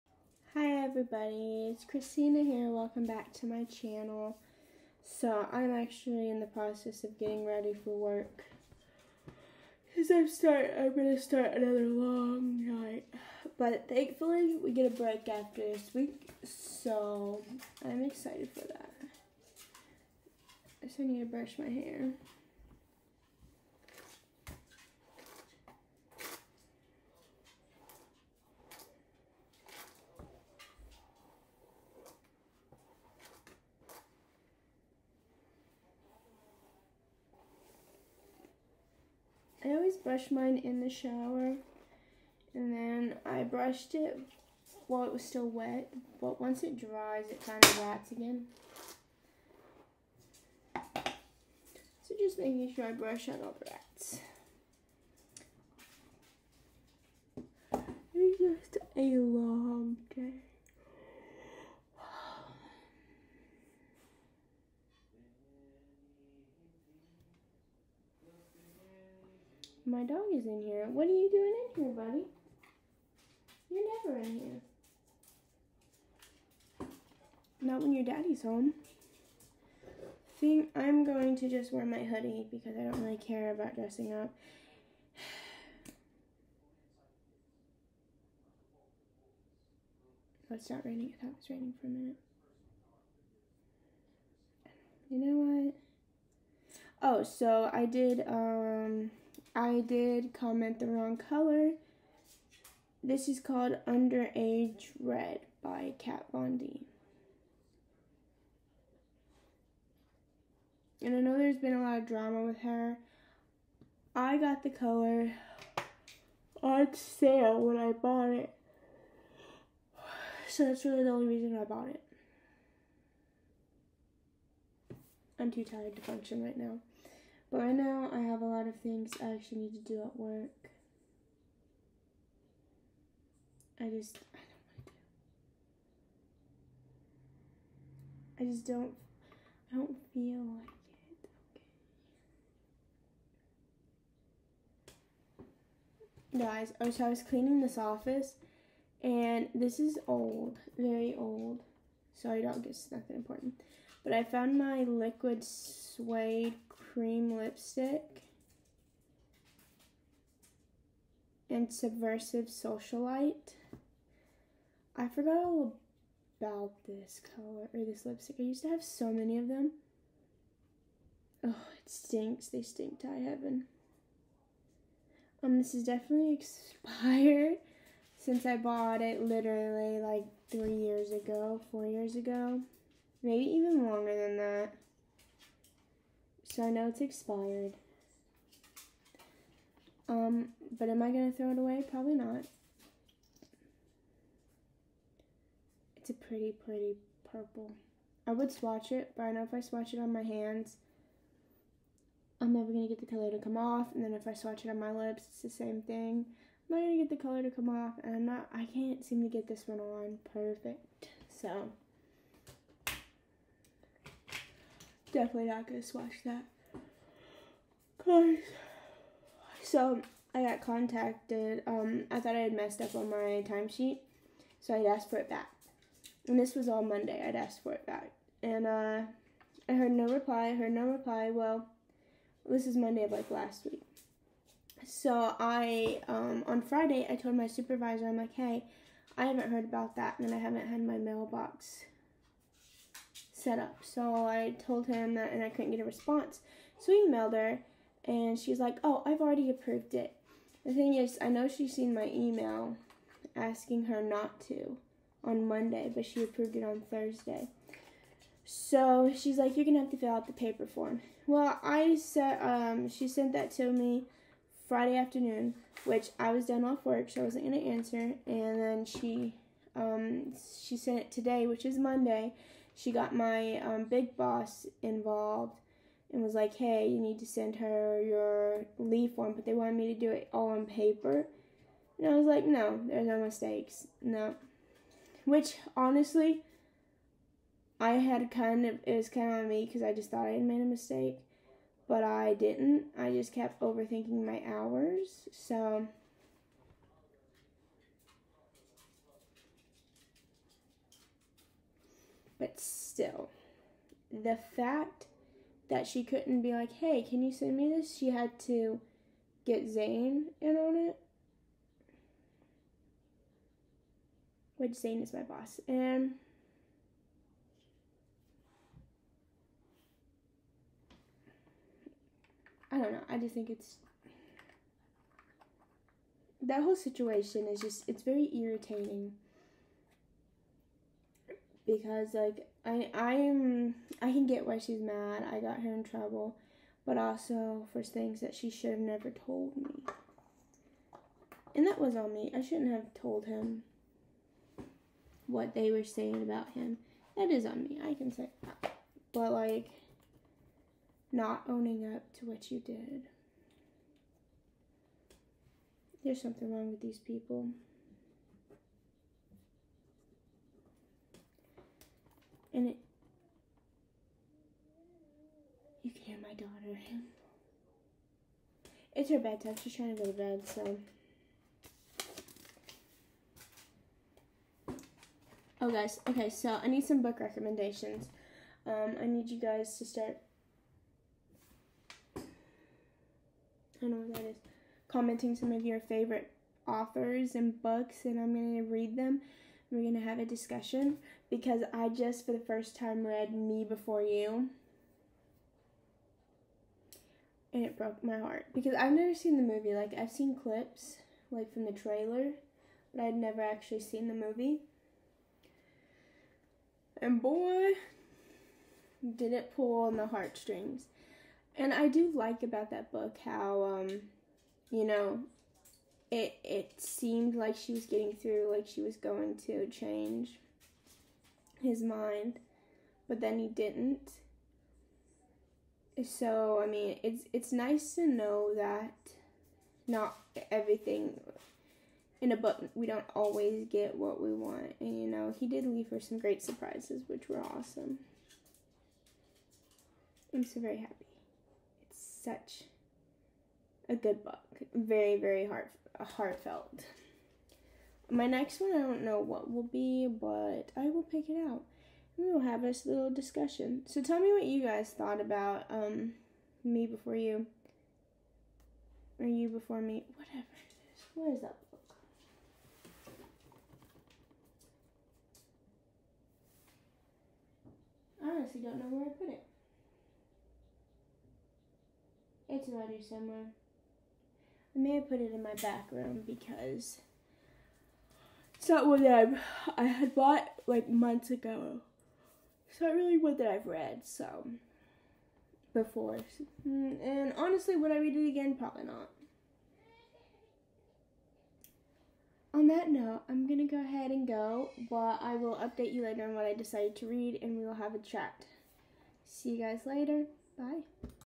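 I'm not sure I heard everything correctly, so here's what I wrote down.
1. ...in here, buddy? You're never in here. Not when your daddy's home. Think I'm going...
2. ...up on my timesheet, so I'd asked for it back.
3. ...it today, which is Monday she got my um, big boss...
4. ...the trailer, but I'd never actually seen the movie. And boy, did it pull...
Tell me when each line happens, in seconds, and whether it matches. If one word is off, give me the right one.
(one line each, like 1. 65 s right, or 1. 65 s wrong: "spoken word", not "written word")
1. 71 s right
2. 222 s right
3. 270 s right
4. 401 s right.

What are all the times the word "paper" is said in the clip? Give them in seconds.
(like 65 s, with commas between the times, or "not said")
260 s, 280 s.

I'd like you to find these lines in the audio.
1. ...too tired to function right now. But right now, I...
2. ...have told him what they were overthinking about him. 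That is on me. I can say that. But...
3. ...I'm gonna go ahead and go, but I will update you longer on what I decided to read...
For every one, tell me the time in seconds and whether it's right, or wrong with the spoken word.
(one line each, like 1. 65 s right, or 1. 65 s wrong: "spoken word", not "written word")
1. 125 s right
2. 342 s wrong: "saying", not "overthinking"
3. 493 s wrong: "later", not "longer".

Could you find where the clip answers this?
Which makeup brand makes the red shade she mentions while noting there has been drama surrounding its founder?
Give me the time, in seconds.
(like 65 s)
105 s.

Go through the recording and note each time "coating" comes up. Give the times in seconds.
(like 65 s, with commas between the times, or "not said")
not said.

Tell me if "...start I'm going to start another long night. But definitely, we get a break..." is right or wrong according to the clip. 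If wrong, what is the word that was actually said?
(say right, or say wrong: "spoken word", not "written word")
wrong: "thankfully", not "definitely".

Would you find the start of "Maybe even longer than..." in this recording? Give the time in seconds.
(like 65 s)
183 s.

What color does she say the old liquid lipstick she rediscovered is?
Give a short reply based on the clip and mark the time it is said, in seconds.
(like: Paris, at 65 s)
purple, at 197 s.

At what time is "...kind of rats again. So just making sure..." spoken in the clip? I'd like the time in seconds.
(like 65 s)
47 s.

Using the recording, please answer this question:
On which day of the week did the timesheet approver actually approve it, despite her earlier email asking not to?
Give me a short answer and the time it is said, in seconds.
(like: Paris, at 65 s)
Thursday, at 256 s.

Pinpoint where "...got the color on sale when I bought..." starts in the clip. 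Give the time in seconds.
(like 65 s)
114 s.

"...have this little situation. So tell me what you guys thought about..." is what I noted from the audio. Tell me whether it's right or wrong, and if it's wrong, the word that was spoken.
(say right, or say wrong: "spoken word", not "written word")
wrong: "discussion", not "situation".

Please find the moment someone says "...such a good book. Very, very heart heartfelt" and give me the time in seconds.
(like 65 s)
442 s.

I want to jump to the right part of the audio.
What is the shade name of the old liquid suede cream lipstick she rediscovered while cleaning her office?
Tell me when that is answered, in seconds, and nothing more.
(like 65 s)
161 s.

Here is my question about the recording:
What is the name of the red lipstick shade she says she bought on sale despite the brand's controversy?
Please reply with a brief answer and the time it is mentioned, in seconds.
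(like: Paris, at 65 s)
Underage Red, at 103 s.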